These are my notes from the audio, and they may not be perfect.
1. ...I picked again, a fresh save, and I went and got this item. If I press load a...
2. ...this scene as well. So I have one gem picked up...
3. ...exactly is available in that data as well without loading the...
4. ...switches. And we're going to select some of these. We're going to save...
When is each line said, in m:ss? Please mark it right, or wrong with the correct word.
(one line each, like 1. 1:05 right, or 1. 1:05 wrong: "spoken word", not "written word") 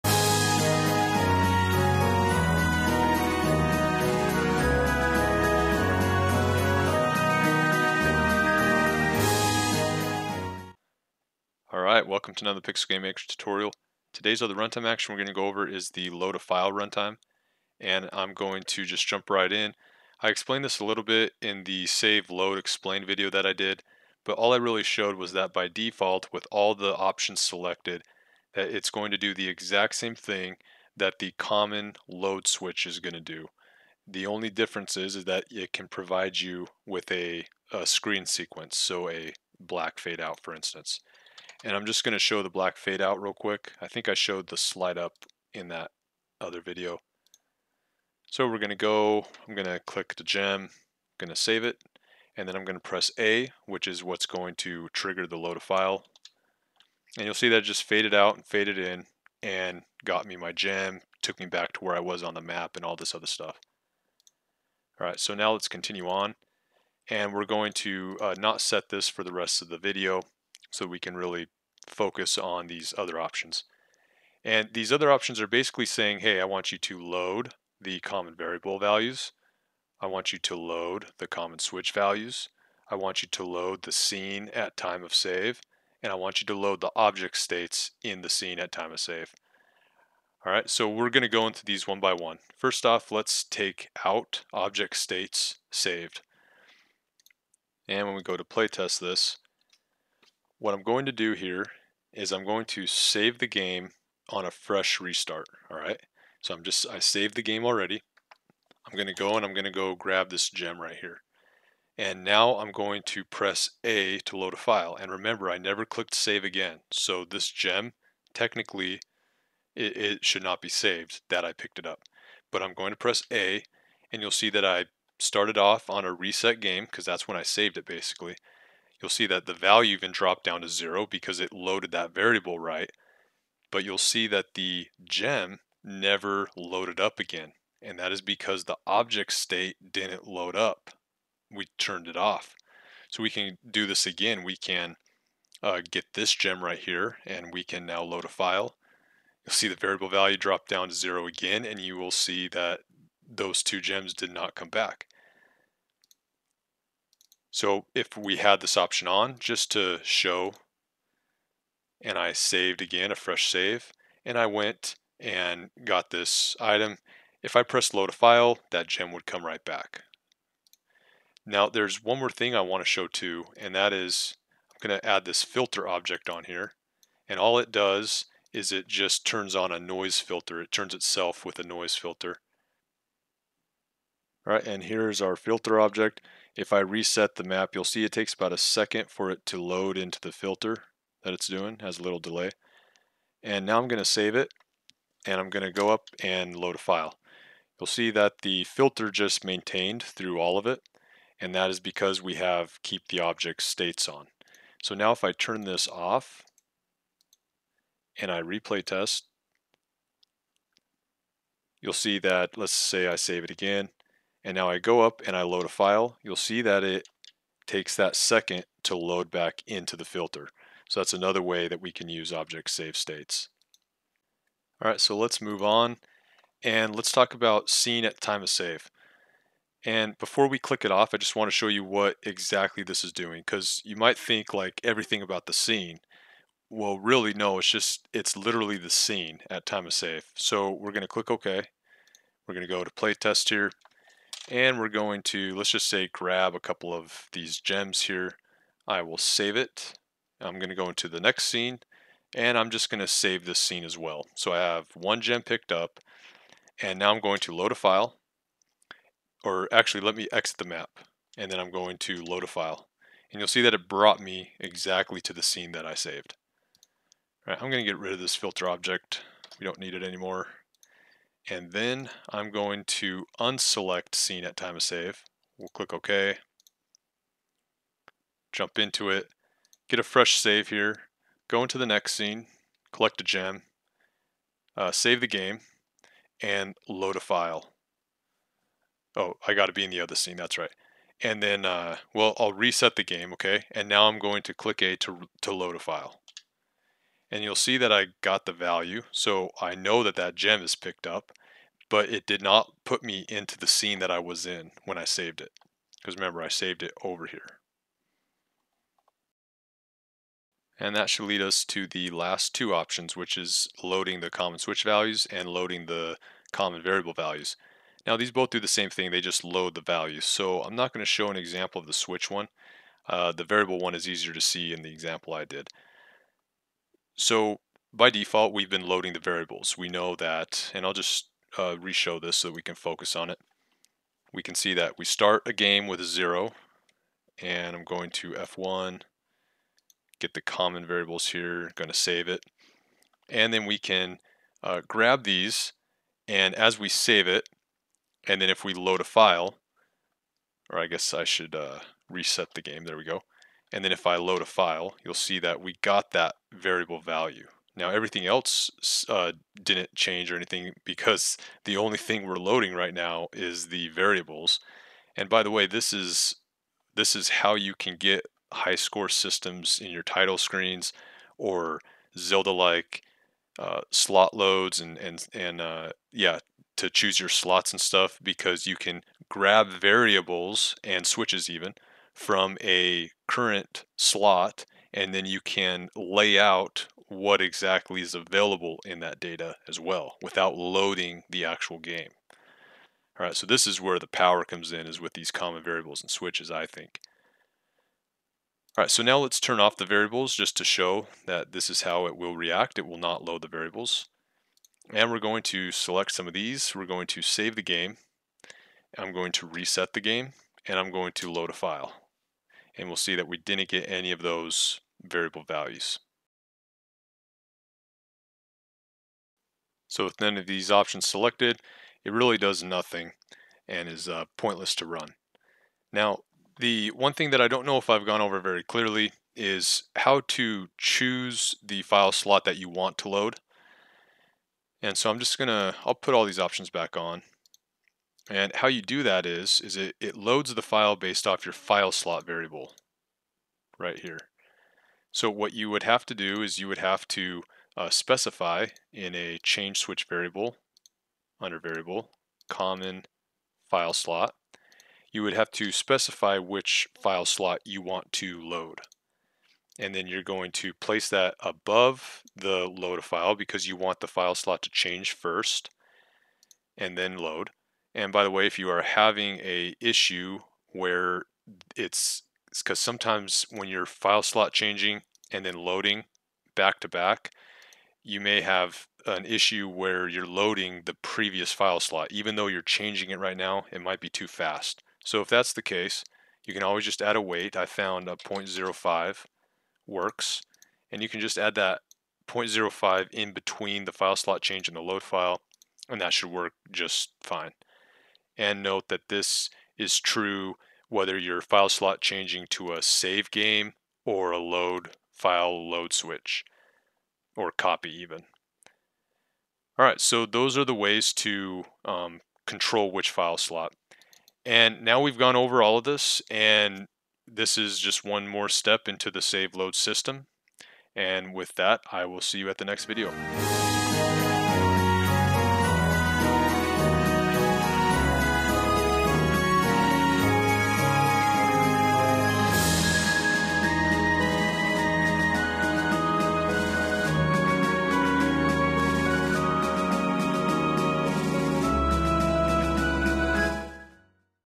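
1. 2:42 wrong: "saved", not "picked"
2. 4:13 right
3. 6:27 right
4. 6:43 wrong: "variables", not "switches".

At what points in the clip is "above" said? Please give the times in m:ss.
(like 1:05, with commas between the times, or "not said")
7:41.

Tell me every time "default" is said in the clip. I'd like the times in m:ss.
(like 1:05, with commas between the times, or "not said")
0:25, 5:28.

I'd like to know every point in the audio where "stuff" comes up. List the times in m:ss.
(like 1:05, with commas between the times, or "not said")
1:03, 6:17.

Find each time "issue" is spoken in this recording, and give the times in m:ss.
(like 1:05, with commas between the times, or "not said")
7:49, 7:59.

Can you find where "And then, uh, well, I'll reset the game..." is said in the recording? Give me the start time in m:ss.
4:51.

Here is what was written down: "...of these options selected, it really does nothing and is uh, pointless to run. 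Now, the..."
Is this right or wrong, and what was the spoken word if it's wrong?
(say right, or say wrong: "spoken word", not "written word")
right.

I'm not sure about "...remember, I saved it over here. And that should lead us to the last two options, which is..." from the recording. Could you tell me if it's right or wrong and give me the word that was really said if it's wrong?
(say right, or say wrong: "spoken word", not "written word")
right.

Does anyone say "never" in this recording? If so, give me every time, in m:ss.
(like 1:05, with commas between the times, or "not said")
1:55, 2:15.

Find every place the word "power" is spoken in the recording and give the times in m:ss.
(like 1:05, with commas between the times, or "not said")
6:34.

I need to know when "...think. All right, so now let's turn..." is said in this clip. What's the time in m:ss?
6:36.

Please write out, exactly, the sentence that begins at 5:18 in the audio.
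Now these both do the same thing, they just load the values.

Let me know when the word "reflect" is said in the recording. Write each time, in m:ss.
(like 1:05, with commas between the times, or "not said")
not said.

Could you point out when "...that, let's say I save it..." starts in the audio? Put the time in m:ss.
3:32.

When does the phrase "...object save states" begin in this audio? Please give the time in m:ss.
3:42.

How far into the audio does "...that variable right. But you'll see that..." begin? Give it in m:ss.
2:11.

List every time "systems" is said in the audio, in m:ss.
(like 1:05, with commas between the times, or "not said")
6:09, 8:39.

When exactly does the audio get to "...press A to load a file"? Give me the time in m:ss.
1:53.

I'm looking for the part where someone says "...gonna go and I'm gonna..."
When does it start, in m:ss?
1:48.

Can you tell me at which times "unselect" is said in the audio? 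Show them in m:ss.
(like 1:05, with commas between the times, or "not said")
4:33.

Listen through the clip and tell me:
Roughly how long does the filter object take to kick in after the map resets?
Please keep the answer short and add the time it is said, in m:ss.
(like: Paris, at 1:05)
About a second, at 3:08.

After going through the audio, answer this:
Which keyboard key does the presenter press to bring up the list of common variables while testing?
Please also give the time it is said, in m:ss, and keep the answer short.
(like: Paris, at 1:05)
F1, at 5:38.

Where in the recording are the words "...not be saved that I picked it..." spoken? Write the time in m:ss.
2:00.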